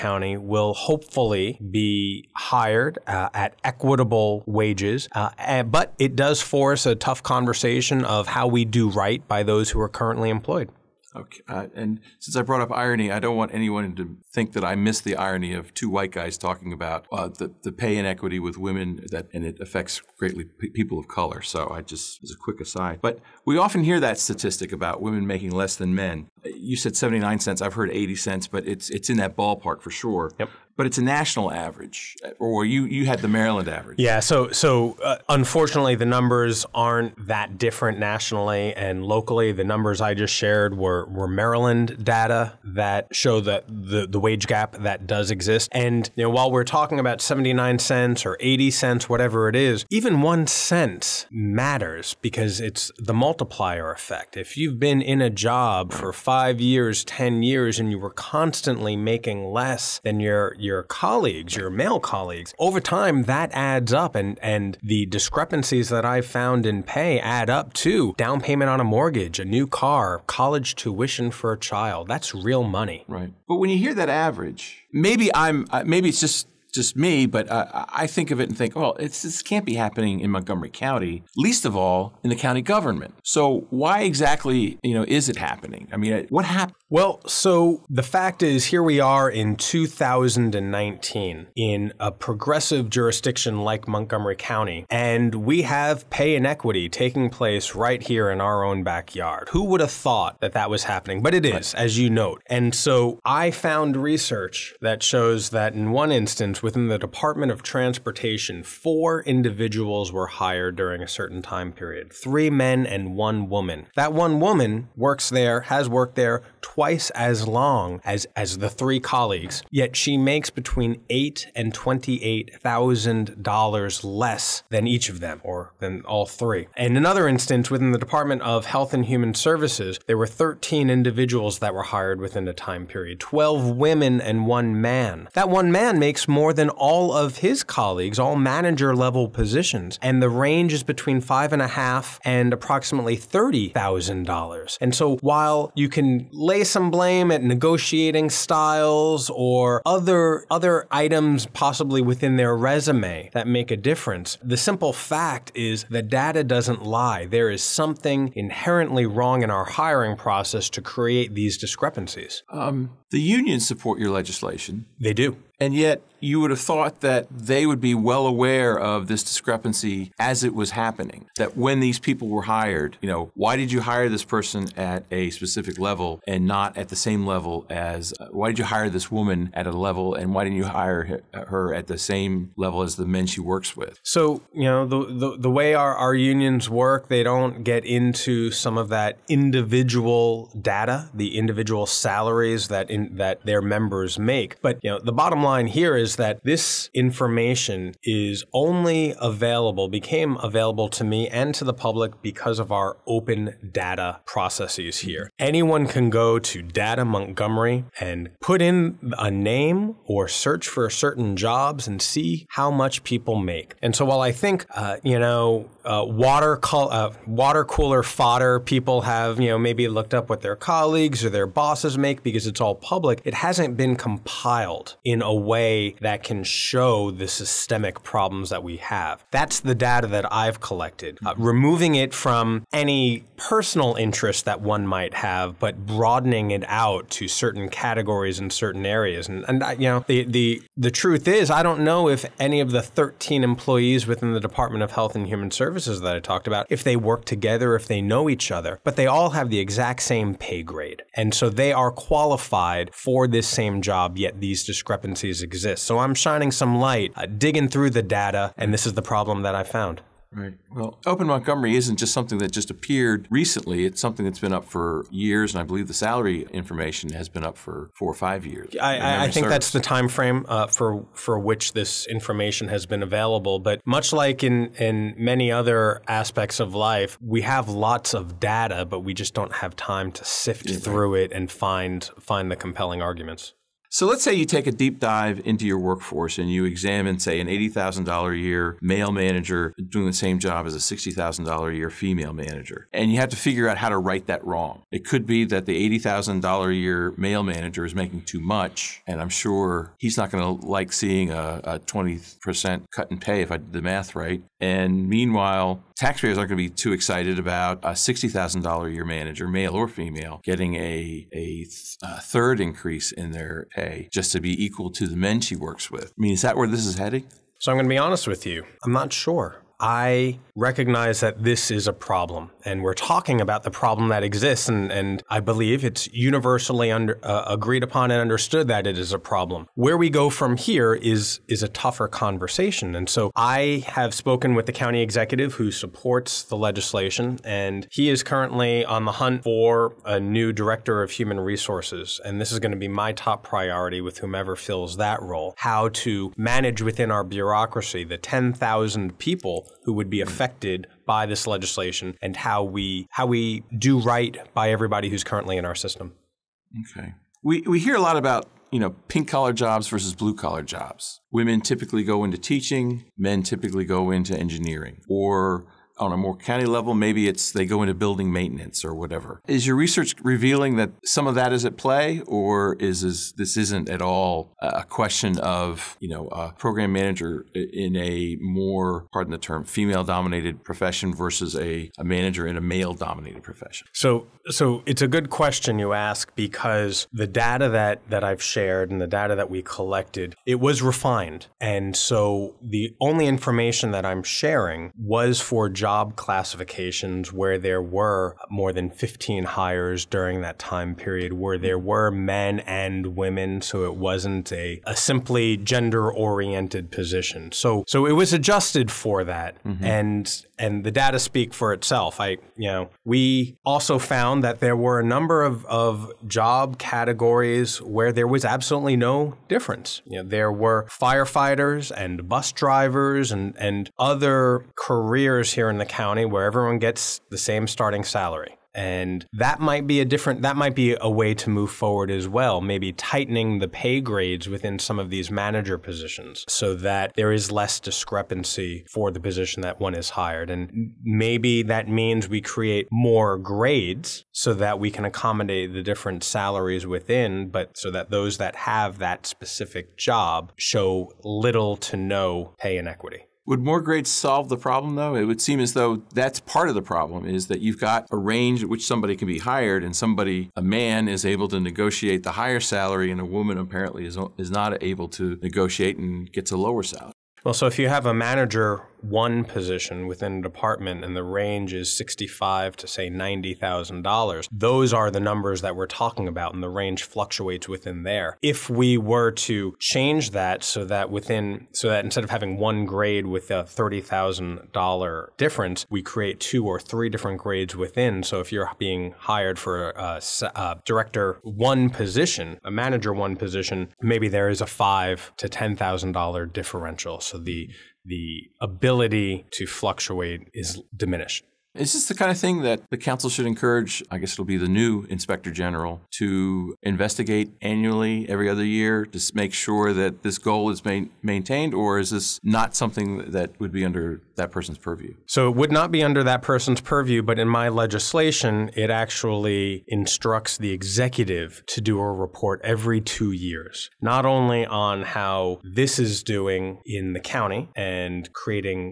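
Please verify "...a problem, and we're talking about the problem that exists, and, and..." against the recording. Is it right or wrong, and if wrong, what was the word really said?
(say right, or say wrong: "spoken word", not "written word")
right.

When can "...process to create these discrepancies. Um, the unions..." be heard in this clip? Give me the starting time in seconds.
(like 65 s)
160 s.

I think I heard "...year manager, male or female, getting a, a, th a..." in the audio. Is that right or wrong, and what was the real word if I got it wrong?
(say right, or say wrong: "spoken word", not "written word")
right.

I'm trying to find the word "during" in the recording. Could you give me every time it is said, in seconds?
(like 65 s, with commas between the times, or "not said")
110 s, 400 s.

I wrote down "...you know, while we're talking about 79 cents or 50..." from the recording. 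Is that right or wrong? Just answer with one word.
wrong.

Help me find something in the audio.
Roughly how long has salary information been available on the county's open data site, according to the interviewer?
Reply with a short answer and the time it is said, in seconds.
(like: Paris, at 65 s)
4 or 5 years, at 267 s.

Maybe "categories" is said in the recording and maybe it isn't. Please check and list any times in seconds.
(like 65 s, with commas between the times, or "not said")
237 s, 416 s.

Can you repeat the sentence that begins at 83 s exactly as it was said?
So why exactly, you know, is it happening?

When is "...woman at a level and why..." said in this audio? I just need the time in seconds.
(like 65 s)
179 s.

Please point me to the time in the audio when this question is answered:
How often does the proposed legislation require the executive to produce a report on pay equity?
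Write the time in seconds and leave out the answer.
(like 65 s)
522 s.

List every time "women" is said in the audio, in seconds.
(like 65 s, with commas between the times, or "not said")
18 s, 25 s, 133 s, 361 s, 403 s.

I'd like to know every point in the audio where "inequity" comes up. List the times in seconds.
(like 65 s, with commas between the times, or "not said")
17 s, 96 s, 452 s.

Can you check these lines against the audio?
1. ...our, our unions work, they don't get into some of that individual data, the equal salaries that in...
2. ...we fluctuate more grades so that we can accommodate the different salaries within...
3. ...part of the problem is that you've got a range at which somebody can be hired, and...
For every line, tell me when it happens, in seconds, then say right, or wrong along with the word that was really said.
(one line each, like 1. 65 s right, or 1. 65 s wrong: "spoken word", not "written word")
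1. 185 s wrong: "individual", not "equal"
2. 442 s wrong: "create", not "fluctuate"
3. 456 s right.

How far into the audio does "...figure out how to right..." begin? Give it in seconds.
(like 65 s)
293 s.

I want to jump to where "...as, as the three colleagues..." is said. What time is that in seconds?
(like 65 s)
118 s.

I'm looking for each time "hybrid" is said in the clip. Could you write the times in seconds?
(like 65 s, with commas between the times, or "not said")
not said.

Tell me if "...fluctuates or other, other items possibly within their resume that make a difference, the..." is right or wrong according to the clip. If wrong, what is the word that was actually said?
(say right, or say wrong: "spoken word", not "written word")
wrong: "styles", not "fluctuates".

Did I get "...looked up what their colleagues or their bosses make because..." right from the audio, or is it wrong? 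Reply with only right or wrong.
right.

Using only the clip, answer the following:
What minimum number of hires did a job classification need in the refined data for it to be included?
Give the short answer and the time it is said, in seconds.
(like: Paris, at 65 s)
More than 15, at 398 s.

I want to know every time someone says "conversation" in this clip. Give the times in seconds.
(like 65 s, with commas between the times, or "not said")
7 s, 332 s.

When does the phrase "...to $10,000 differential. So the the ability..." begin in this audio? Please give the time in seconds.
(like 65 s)
495 s.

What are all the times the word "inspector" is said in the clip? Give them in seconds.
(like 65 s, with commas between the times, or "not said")
505 s.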